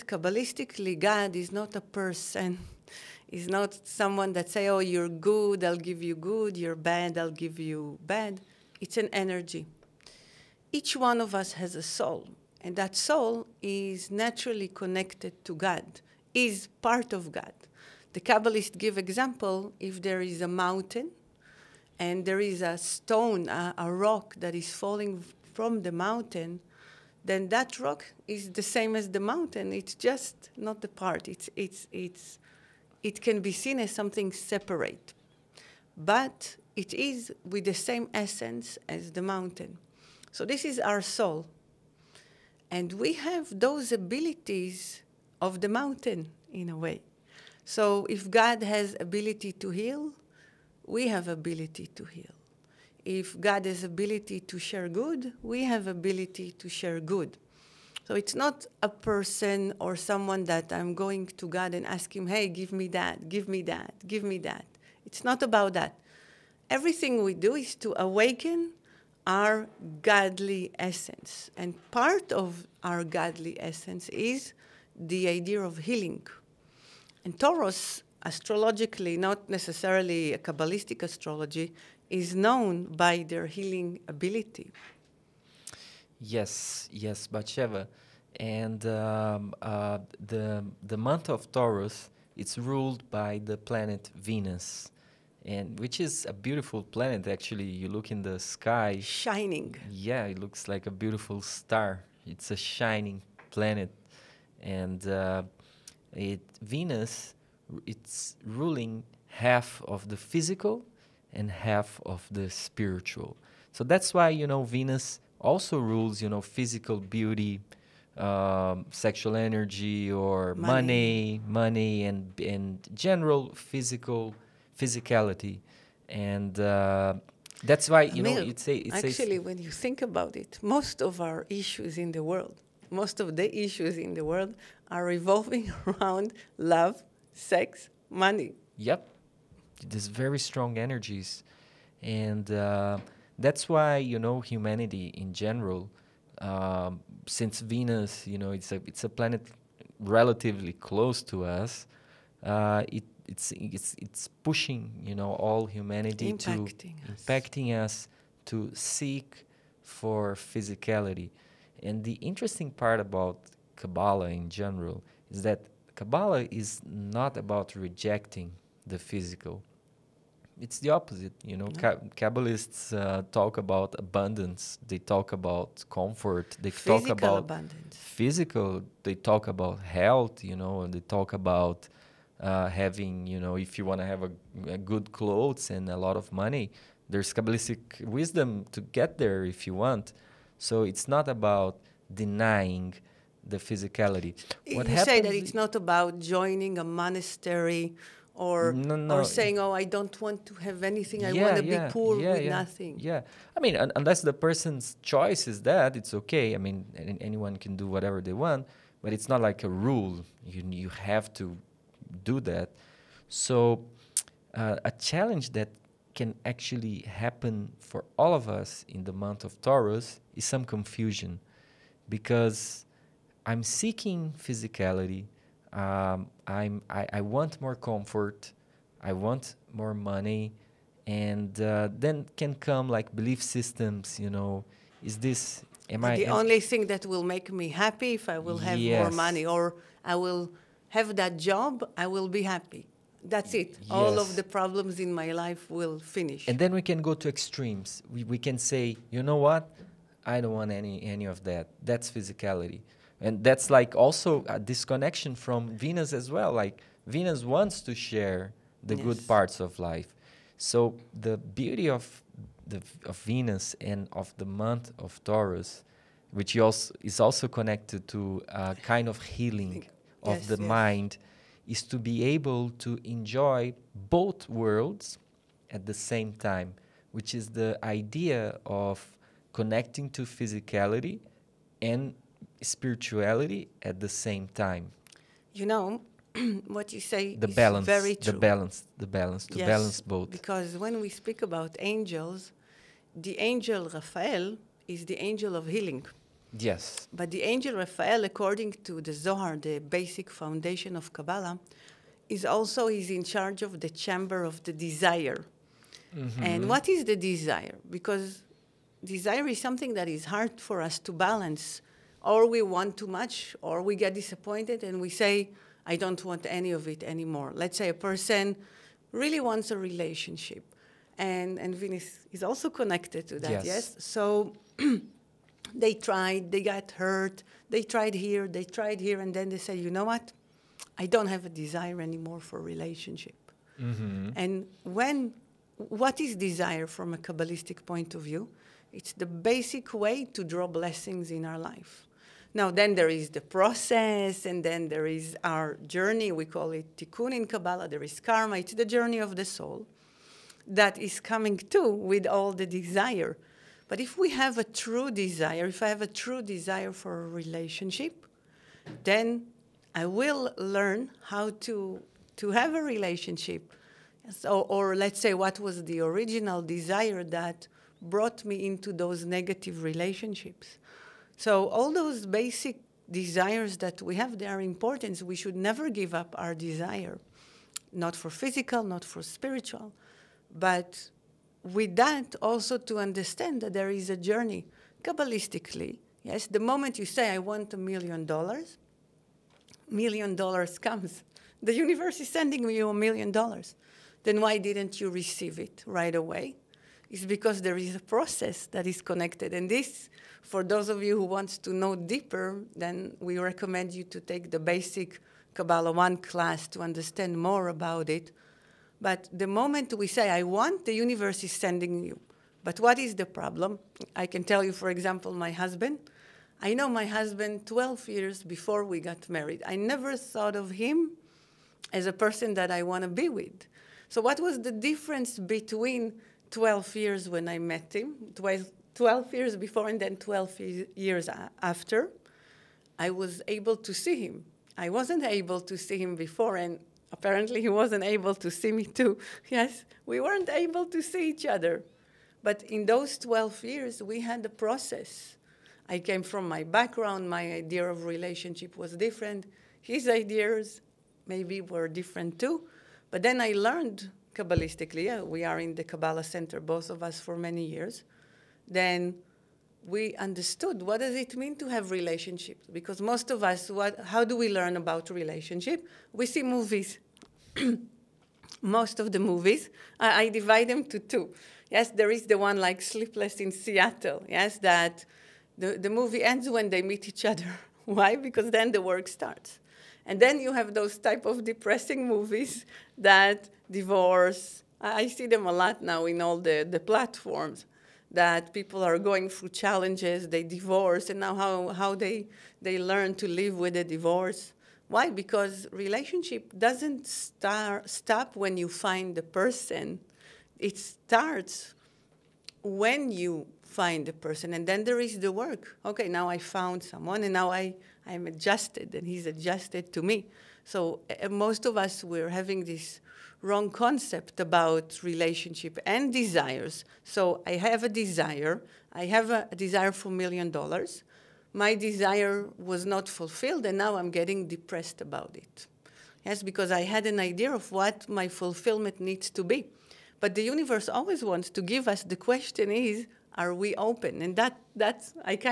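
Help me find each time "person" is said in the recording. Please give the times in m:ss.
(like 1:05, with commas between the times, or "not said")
0:01, 0:58, 3:24, 5:17, 7:02, 8:19, 8:24.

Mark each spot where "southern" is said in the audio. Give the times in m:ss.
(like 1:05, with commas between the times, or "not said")
not said.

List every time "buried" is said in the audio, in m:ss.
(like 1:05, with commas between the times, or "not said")
not said.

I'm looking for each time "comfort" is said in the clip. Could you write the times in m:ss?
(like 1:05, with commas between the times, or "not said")
2:55, 3:47.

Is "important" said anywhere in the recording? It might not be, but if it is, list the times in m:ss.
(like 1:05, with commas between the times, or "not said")
6:14.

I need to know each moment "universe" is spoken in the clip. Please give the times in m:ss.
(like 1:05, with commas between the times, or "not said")
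6:31, 6:50, 8:50.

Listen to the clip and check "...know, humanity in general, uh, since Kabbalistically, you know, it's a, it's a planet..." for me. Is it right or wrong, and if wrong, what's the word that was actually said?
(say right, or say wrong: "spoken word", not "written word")
wrong: "Venus", not "Kabbalistically".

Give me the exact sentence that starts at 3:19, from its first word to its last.
or saying, "Oh, I don't want to have anything.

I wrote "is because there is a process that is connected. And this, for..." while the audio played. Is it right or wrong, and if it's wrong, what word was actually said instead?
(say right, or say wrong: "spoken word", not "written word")
right.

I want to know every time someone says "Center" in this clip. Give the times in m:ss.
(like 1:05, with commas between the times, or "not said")
7:36.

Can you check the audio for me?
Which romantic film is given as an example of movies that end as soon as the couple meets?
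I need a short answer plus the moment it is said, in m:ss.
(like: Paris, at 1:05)
Sleepless in Seattle, at 7:52.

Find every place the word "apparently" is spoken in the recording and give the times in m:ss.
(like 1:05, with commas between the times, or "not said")
7:17.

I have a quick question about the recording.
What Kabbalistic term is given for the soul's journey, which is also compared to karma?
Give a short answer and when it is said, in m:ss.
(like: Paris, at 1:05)
Tikkun, at 5:46.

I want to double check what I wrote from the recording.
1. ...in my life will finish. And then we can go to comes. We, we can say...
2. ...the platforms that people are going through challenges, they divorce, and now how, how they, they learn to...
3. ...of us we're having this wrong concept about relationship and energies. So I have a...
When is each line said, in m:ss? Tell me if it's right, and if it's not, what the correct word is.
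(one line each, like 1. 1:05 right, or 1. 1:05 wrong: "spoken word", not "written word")
1. 4:05 wrong: "extremes", not "comes"
2. 8:06 right
3. 8:31 wrong: "desires", not "energies".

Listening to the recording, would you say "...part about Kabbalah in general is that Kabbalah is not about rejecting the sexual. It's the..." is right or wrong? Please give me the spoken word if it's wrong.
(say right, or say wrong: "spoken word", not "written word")
wrong: "physical", not "sexual".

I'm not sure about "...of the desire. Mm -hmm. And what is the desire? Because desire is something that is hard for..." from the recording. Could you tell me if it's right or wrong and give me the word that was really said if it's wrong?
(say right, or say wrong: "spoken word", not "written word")
right.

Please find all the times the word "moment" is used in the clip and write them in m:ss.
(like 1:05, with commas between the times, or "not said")
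6:26, 6:49.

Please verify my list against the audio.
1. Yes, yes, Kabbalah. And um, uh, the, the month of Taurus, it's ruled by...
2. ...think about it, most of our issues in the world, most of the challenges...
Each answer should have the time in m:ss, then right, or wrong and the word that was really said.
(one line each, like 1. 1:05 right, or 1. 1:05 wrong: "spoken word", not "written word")
1. 1:26 wrong: "Batsheva", not "Kabbalah"
2. 2:09 wrong: "issues", not "challenges".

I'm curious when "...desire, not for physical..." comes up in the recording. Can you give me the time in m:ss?
6:16.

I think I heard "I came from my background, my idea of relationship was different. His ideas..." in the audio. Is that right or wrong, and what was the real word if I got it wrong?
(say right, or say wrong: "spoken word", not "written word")
right.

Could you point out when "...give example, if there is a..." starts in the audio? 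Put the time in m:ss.
0:18.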